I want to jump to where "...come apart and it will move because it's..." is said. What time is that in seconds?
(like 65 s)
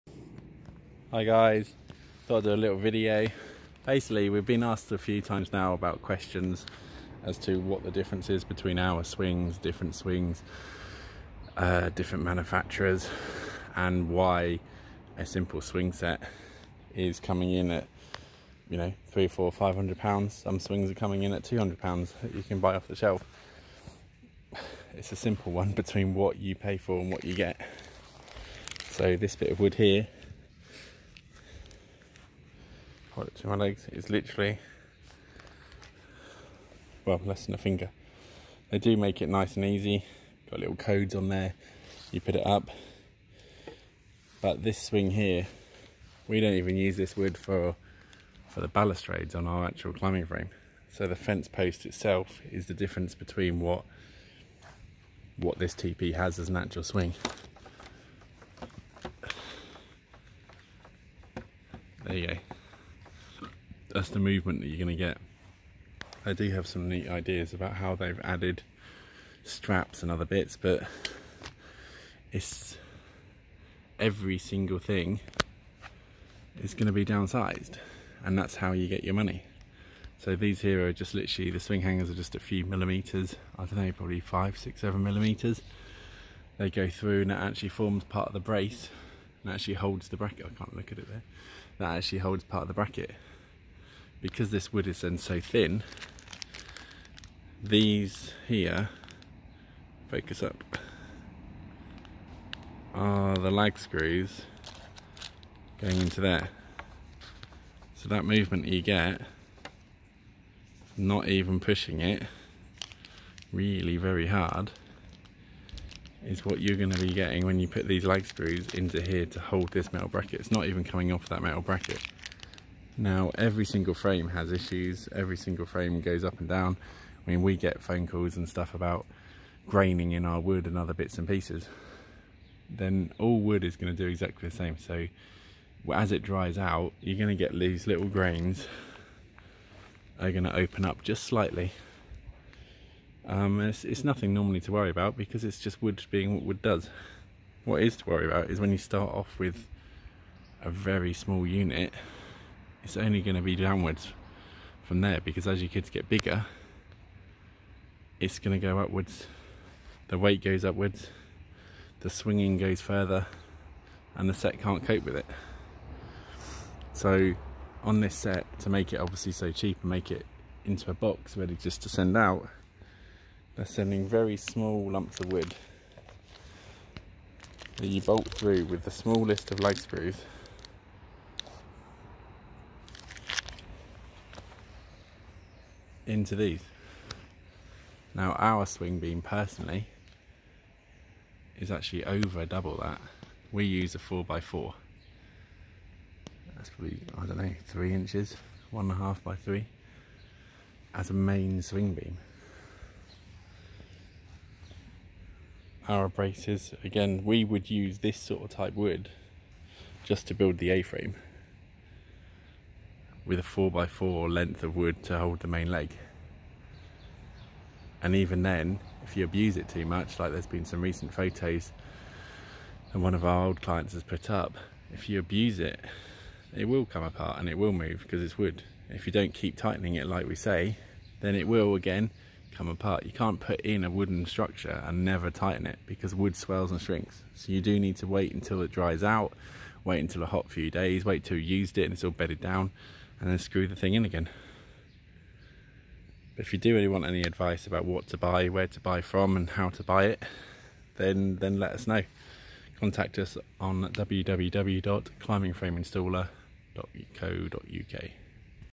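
226 s.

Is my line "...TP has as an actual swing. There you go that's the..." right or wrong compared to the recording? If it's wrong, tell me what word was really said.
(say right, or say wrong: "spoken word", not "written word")
right.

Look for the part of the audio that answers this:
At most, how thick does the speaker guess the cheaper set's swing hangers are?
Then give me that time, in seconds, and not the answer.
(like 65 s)
84 s.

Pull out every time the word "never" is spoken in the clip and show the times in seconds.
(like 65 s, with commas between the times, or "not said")
235 s.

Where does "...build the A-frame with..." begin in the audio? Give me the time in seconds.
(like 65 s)
210 s.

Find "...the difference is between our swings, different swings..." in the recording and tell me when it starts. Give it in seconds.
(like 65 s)
7 s.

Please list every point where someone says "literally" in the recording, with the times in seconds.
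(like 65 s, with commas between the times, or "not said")
34 s, 81 s.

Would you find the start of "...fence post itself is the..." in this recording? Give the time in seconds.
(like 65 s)
51 s.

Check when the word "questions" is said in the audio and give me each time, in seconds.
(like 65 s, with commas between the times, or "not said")
6 s.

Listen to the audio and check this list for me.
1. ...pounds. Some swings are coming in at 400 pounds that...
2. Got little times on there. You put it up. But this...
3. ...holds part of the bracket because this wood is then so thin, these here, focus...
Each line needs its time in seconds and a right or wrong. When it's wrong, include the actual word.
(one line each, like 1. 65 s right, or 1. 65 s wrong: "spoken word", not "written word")
1. 19 s wrong: "200", not "400"
2. 40 s wrong: "codes", not "times"
3. 92 s right.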